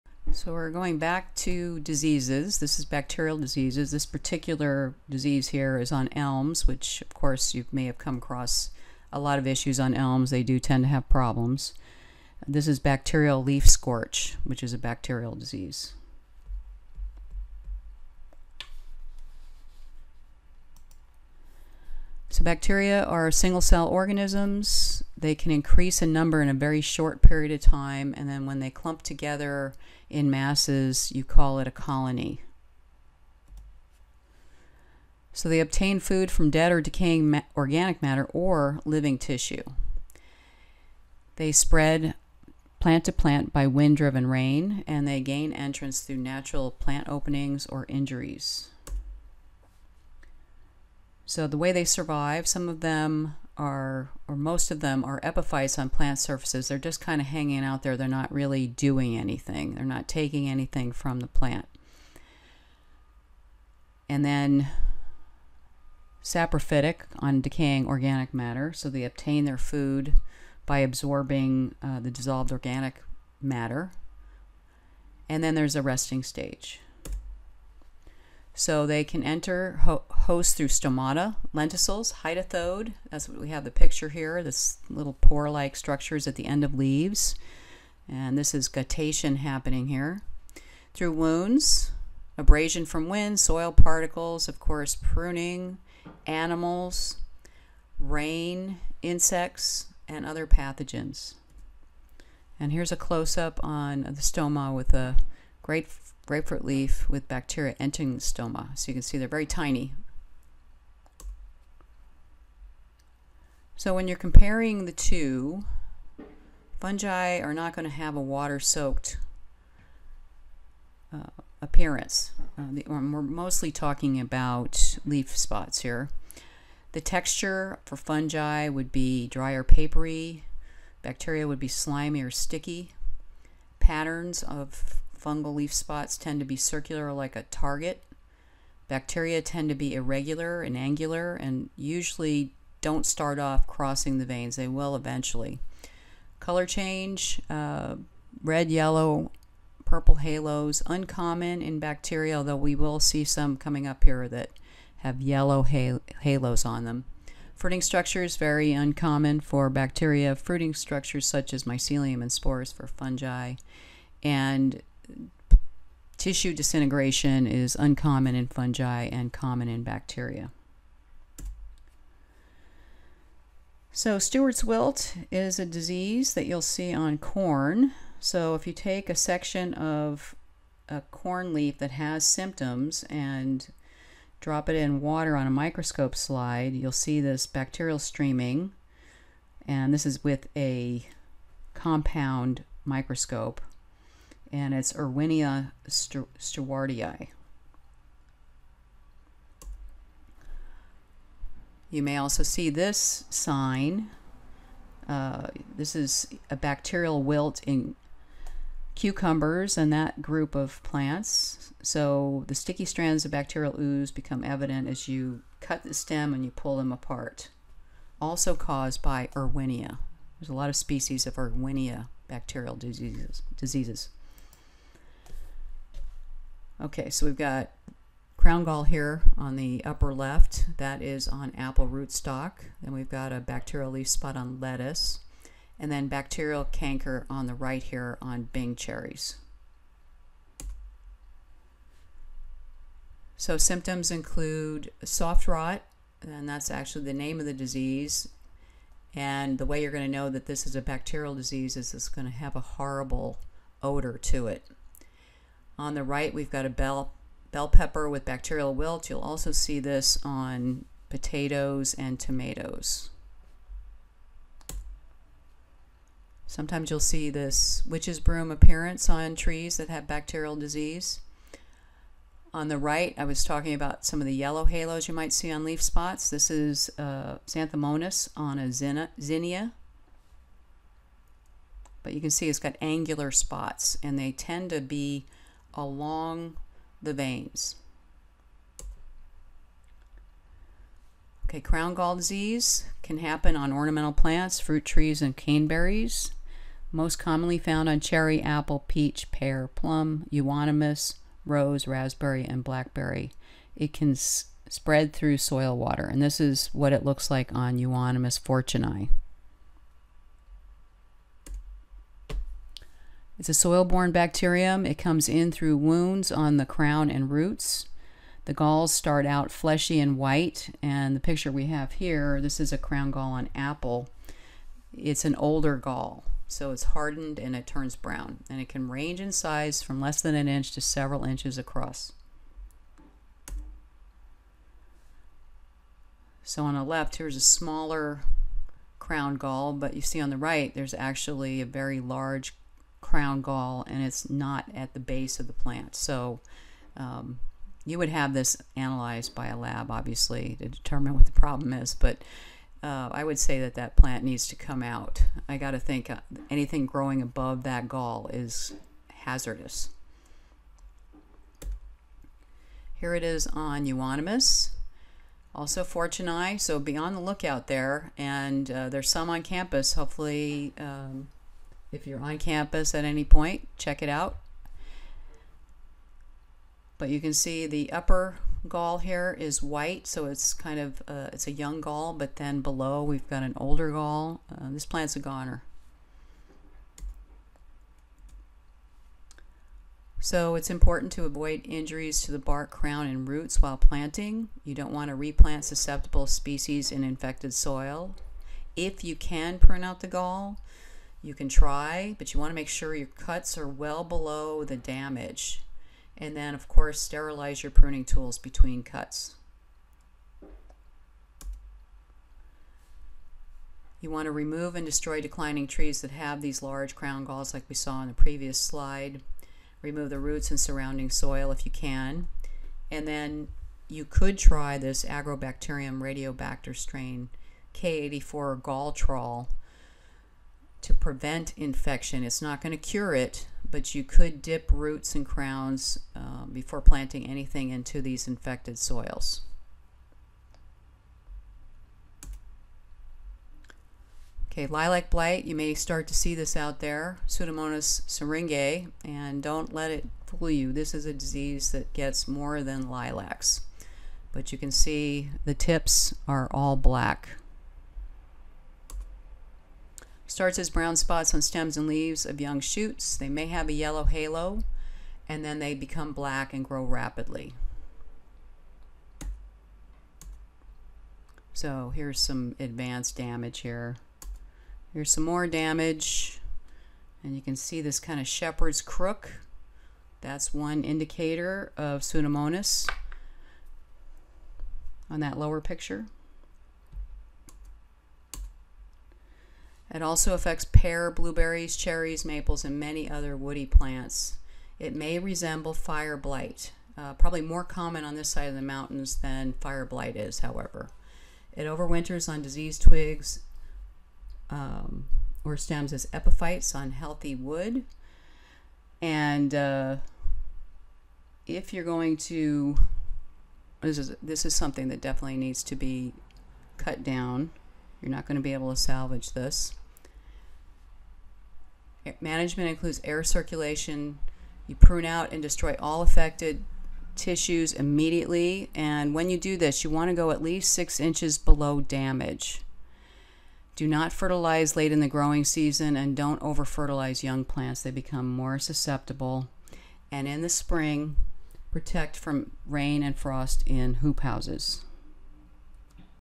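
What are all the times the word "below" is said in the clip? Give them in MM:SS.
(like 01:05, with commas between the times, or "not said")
06:22, 06:44, 08:51.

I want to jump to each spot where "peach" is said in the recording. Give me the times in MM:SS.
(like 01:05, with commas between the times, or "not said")
04:58.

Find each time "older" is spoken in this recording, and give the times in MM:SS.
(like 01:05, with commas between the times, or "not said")
05:25, 06:23.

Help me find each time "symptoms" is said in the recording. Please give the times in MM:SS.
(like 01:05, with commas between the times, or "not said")
03:02, 04:03.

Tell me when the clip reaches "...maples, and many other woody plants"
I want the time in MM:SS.
08:12.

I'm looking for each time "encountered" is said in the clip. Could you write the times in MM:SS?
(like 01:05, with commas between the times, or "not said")
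not said.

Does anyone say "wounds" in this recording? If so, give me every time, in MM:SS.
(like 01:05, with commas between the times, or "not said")
01:31, 05:15.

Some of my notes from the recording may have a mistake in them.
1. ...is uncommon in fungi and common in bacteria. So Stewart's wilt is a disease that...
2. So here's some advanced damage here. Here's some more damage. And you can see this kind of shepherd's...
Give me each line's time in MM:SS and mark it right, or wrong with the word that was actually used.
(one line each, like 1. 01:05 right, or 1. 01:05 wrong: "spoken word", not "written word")
1. 02:47 right
2. 07:51 right.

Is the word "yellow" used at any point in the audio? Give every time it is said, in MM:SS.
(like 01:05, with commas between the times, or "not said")
02:28, 02:35, 04:34, 07:43.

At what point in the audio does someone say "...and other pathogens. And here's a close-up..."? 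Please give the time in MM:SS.
01:40.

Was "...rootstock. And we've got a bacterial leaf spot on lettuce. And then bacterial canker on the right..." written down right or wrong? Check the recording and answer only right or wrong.
right.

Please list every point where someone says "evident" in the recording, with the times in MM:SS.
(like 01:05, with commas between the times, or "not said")
03:34.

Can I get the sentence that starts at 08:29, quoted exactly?
And uh, if you're going to, this is, this is something that definitely needs to be cut down.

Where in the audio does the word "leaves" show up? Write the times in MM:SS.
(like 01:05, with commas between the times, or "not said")
01:26, 07:41.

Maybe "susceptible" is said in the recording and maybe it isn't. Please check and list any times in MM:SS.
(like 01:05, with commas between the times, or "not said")
06:35, 08:58.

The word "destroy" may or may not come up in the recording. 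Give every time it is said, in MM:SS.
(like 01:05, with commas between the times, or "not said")
06:54, 08:45.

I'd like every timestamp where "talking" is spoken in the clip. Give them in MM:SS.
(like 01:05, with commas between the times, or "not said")
02:03, 04:33.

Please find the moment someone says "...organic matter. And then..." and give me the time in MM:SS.
01:12.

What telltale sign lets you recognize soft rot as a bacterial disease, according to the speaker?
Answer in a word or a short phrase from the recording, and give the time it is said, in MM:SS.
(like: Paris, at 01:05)
A horrible odor, at 04:12.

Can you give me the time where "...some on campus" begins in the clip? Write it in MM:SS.
06:09.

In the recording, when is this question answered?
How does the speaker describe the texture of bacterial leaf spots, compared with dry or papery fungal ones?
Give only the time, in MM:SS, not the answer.
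02:11.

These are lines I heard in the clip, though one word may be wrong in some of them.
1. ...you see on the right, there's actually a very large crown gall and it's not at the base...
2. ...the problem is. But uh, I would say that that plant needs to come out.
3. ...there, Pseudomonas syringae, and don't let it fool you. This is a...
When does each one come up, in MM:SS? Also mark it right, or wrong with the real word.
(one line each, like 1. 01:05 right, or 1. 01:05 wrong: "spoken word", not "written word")
1. 05:39 right
2. 05:51 right
3. 07:26 right.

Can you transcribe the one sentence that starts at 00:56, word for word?
They're just kind of hanging out there.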